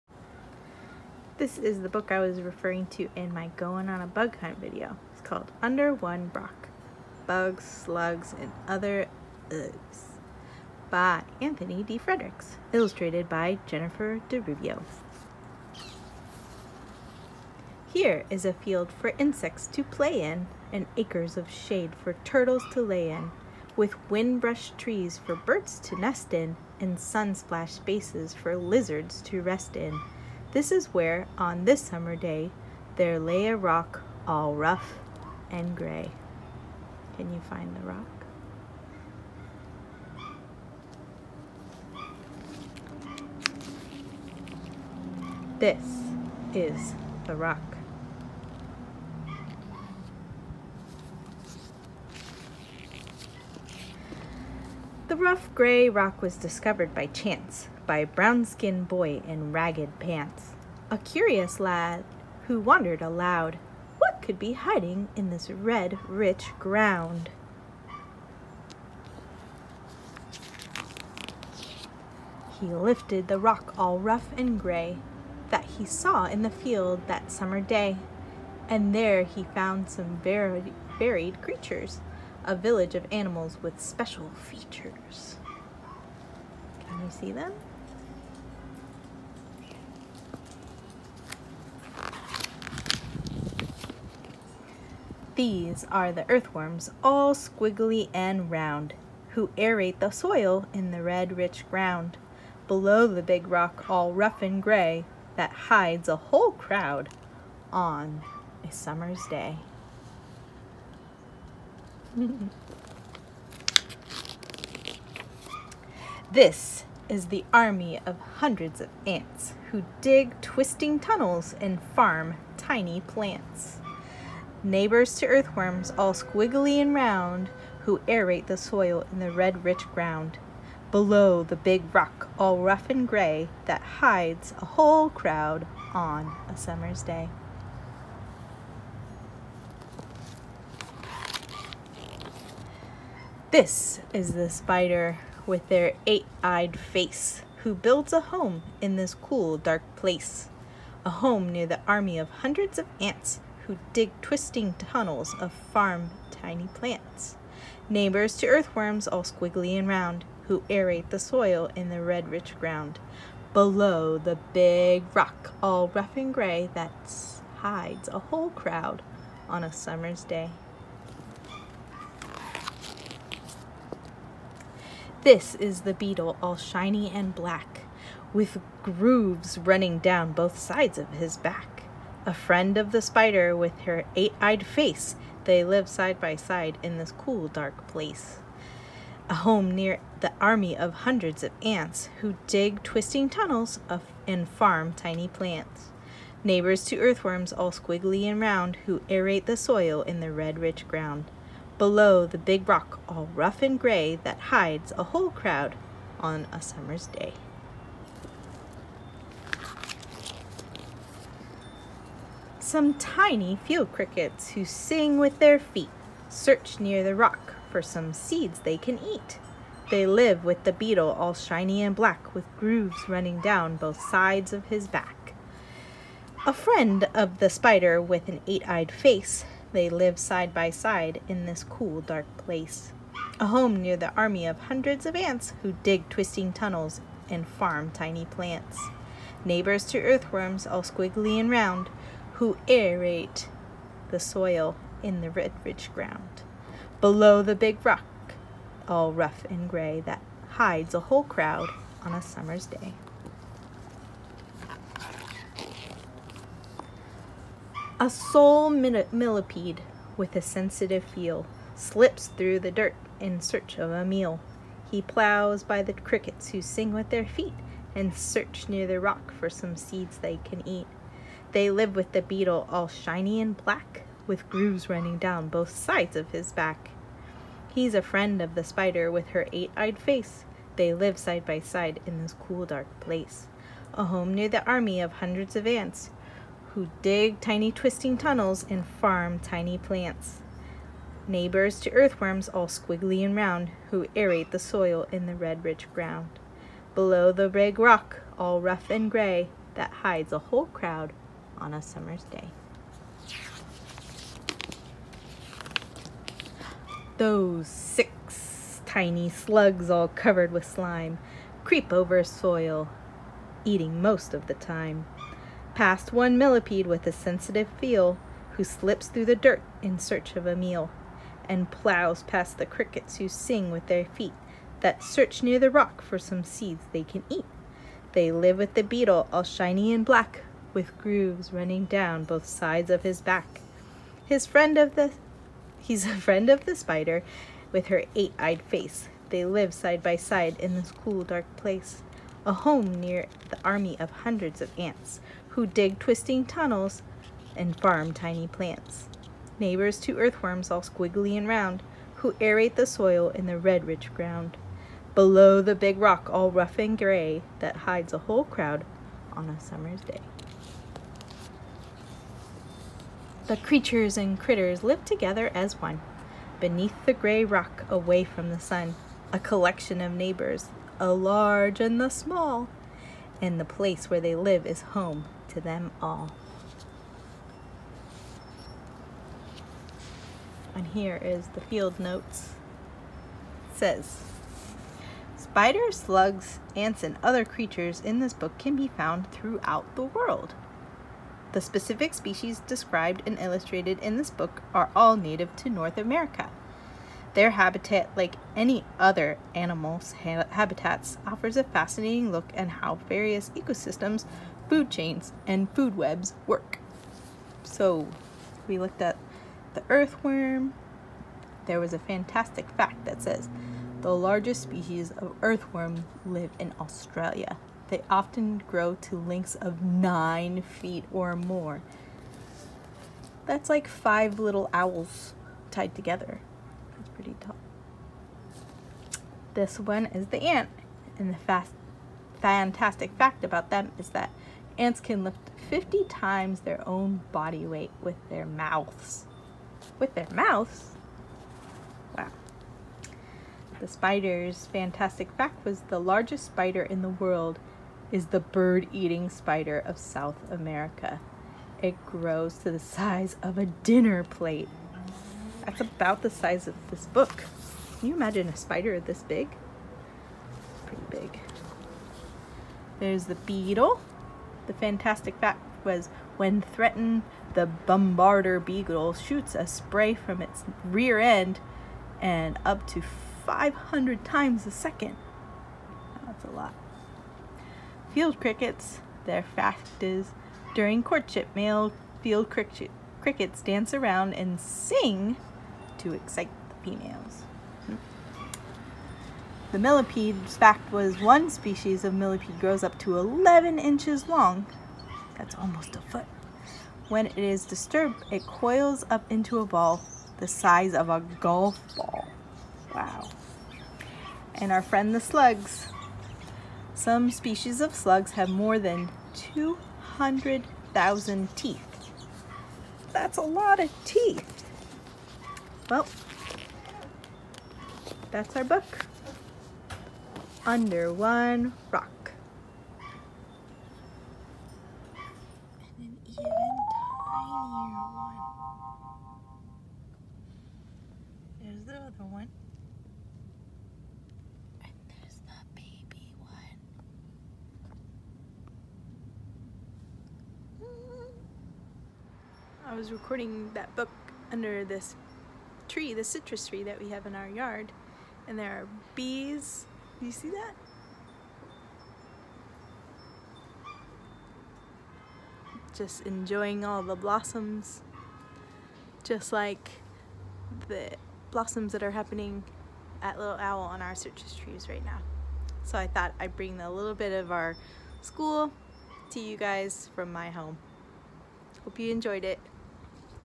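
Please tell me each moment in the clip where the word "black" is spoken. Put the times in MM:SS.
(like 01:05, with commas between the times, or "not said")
02:57, 03:41, 04:33, 05:30.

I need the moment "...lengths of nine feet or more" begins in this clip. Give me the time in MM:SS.
06:59.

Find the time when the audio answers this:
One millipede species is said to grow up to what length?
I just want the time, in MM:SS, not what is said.
08:13.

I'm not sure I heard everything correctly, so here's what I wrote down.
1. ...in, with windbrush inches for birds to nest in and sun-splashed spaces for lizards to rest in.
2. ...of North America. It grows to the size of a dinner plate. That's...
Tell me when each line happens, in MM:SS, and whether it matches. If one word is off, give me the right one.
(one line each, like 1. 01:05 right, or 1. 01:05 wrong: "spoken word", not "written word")
1. 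00:23 wrong: "trees", not "inches"
2. 07:29 wrong: "South", not "North".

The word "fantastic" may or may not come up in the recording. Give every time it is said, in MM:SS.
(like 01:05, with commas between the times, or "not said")
06:51, 07:12, 07:24, 07:44.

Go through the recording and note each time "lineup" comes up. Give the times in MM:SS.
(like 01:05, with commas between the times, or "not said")
not said.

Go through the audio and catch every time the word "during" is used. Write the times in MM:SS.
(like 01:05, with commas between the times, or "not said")
08:00.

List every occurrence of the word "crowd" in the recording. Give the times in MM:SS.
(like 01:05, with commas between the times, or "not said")
01:46, 02:15, 02:48, 03:25, 04:11, 05:00, 05:58.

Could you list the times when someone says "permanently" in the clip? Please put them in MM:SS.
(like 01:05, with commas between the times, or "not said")
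not said.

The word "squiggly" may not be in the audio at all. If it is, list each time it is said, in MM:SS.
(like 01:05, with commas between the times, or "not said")
01:37, 02:06, 02:39, 03:17, 04:00, 04:52, 05:50.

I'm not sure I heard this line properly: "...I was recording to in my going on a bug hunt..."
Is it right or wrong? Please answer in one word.
wrong.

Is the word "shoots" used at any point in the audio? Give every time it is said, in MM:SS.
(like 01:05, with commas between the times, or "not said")
07:49.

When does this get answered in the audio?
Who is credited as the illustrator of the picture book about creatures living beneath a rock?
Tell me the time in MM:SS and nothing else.
00:13.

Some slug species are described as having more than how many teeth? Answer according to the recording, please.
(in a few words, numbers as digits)
200,000.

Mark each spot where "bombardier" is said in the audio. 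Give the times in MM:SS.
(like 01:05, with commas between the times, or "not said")
07:47.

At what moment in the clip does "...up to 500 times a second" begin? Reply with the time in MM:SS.
07:52.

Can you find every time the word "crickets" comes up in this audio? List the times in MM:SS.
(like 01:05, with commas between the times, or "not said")
03:33, 04:25, 05:22, 07:58, 08:02.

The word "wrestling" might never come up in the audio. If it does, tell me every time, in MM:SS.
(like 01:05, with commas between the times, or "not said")
not said.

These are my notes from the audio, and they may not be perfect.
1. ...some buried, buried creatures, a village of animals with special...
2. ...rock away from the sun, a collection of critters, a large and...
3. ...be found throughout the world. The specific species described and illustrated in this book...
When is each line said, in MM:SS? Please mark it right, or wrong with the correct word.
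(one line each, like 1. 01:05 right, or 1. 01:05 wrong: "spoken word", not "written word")
1. 01:19 right
2. 06:07 wrong: "neighbors", not "critters"
3. 06:28 right.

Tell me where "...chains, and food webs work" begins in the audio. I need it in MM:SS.
06:44.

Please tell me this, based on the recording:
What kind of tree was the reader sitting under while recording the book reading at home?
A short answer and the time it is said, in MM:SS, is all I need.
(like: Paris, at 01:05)
citrus tree, at 09:06.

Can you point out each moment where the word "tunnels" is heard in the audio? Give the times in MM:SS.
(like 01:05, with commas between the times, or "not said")
02:00, 02:34, 03:13, 03:56, 04:48, 05:46.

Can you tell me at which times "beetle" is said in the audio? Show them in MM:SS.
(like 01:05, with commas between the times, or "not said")
02:55, 03:40, 04:32, 05:28, 07:43, 07:48.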